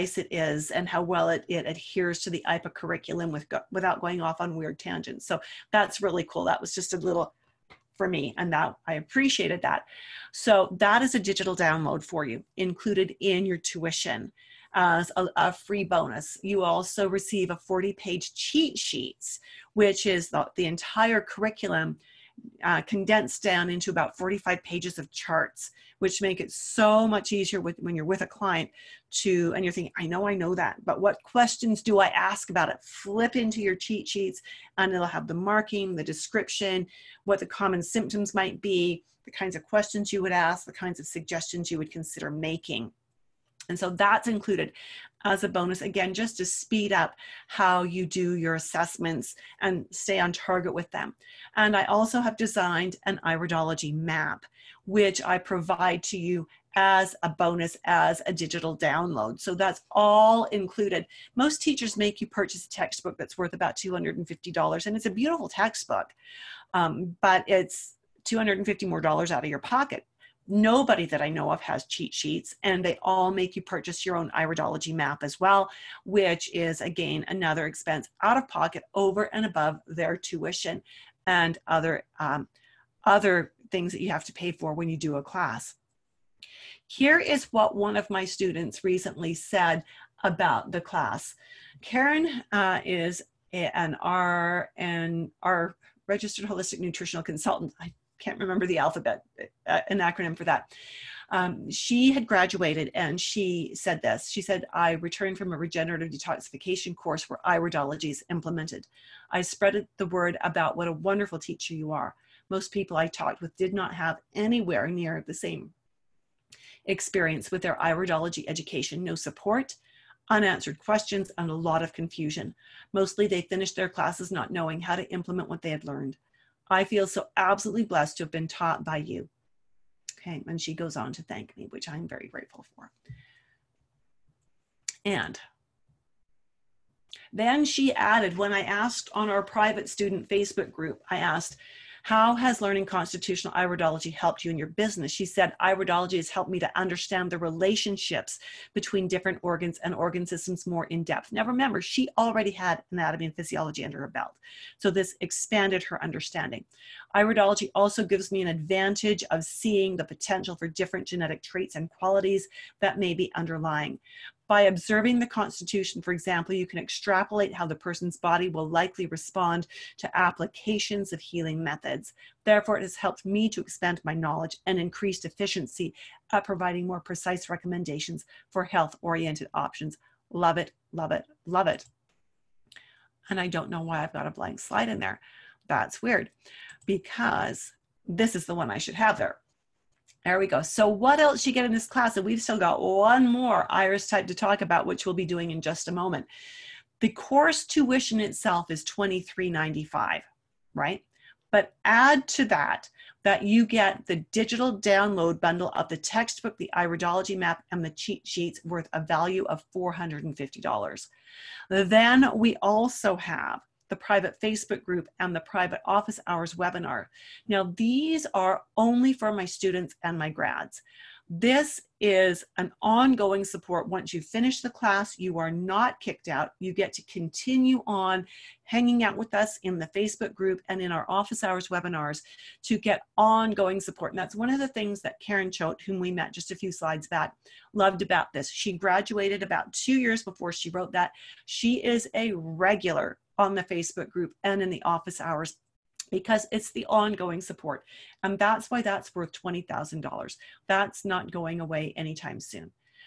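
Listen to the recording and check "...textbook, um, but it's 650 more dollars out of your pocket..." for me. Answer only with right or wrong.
wrong.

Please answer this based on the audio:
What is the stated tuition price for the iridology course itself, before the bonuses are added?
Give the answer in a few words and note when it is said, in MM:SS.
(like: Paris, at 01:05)
$23.95, at 03:18.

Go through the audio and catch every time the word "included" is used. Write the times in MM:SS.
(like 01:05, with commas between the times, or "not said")
00:12, 00:44, 01:00.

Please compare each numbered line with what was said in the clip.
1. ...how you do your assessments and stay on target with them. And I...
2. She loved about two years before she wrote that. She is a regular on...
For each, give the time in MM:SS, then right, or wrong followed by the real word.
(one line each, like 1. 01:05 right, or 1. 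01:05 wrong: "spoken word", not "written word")
1. 00:47 right
2. 03:58 wrong: "graduated", not "loved".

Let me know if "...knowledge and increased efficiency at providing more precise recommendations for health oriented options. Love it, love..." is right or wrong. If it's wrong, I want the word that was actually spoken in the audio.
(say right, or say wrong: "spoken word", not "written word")
right.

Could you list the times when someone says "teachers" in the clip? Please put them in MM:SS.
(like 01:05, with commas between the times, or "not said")
01:01, 01:51.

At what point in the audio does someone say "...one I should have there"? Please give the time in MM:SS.
03:08.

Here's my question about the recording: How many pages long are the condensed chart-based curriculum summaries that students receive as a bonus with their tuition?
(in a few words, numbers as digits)
40.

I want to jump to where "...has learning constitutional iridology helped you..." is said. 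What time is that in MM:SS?
02:22.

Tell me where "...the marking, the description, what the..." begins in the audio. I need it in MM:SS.
00:35.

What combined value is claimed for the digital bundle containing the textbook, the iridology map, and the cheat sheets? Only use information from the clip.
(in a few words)
$450.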